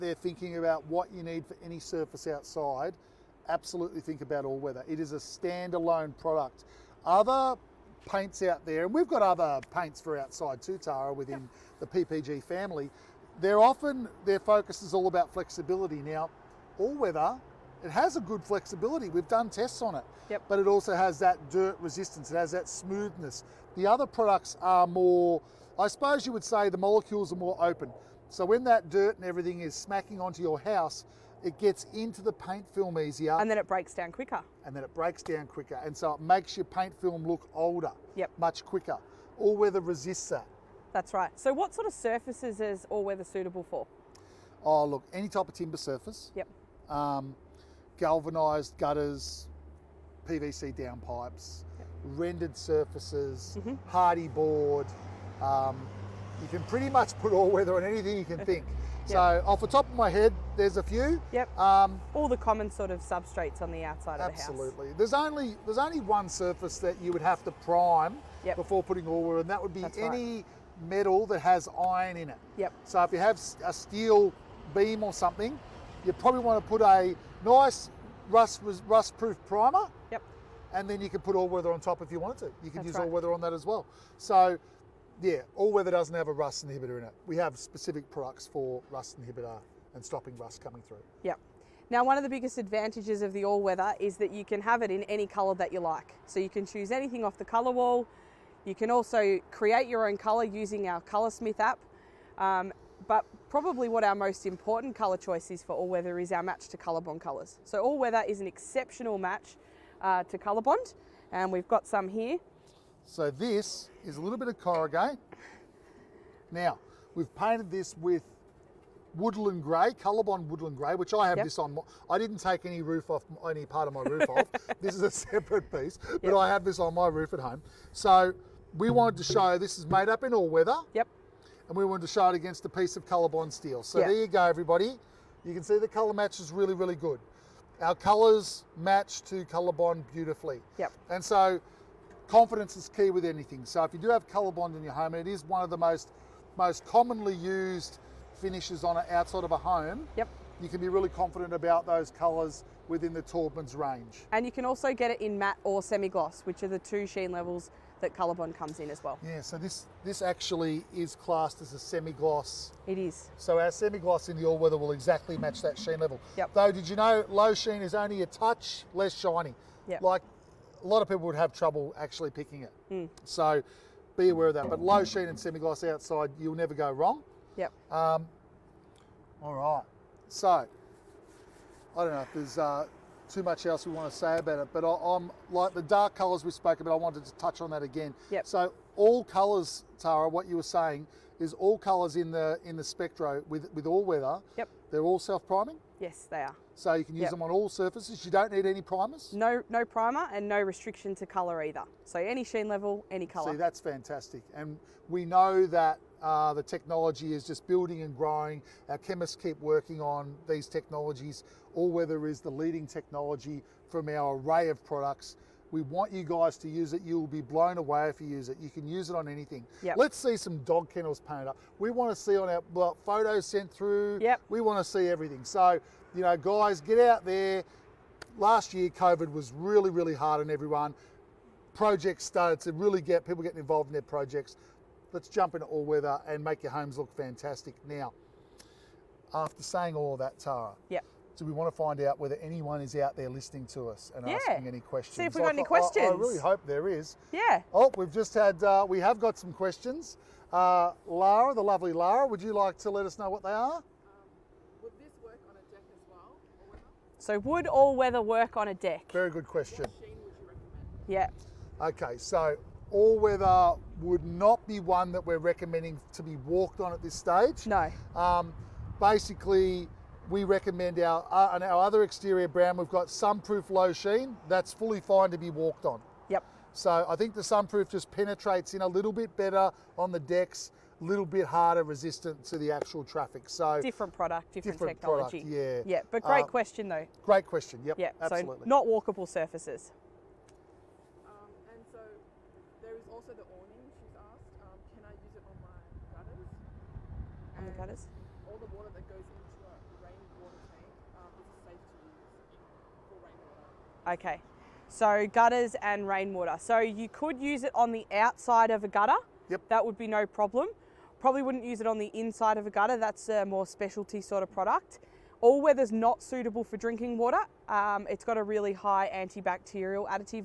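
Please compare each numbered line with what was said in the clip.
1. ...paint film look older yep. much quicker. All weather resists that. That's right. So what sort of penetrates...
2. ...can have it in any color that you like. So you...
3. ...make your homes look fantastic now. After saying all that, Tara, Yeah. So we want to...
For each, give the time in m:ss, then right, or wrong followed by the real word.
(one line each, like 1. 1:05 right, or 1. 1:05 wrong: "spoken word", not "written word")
1. 0:36 wrong: "surfaces", not "penetrates"
2. 1:34 right
3. 3:56 right.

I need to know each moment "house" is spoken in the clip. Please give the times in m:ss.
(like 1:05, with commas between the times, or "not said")
0:30, 1:04.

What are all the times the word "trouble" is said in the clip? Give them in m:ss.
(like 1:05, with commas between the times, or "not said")
2:51.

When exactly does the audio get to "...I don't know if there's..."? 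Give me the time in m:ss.
3:01.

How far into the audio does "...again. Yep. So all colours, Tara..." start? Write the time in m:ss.
3:07.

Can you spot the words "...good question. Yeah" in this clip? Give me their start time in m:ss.
4:19.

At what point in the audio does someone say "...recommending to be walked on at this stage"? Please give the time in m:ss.
4:25.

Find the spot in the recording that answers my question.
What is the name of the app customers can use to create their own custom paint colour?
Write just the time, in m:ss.
1:41.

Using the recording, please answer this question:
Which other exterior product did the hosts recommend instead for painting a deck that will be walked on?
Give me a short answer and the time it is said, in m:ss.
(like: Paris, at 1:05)
Sunproof Low Sheen, at 4:33.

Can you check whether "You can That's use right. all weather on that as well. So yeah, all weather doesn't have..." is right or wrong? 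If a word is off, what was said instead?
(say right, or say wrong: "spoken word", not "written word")
right.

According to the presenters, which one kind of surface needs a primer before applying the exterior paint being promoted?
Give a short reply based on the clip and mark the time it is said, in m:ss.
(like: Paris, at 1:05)
Metal that has iron in it, at 1:10.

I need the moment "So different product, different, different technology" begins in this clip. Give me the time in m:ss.
4:43.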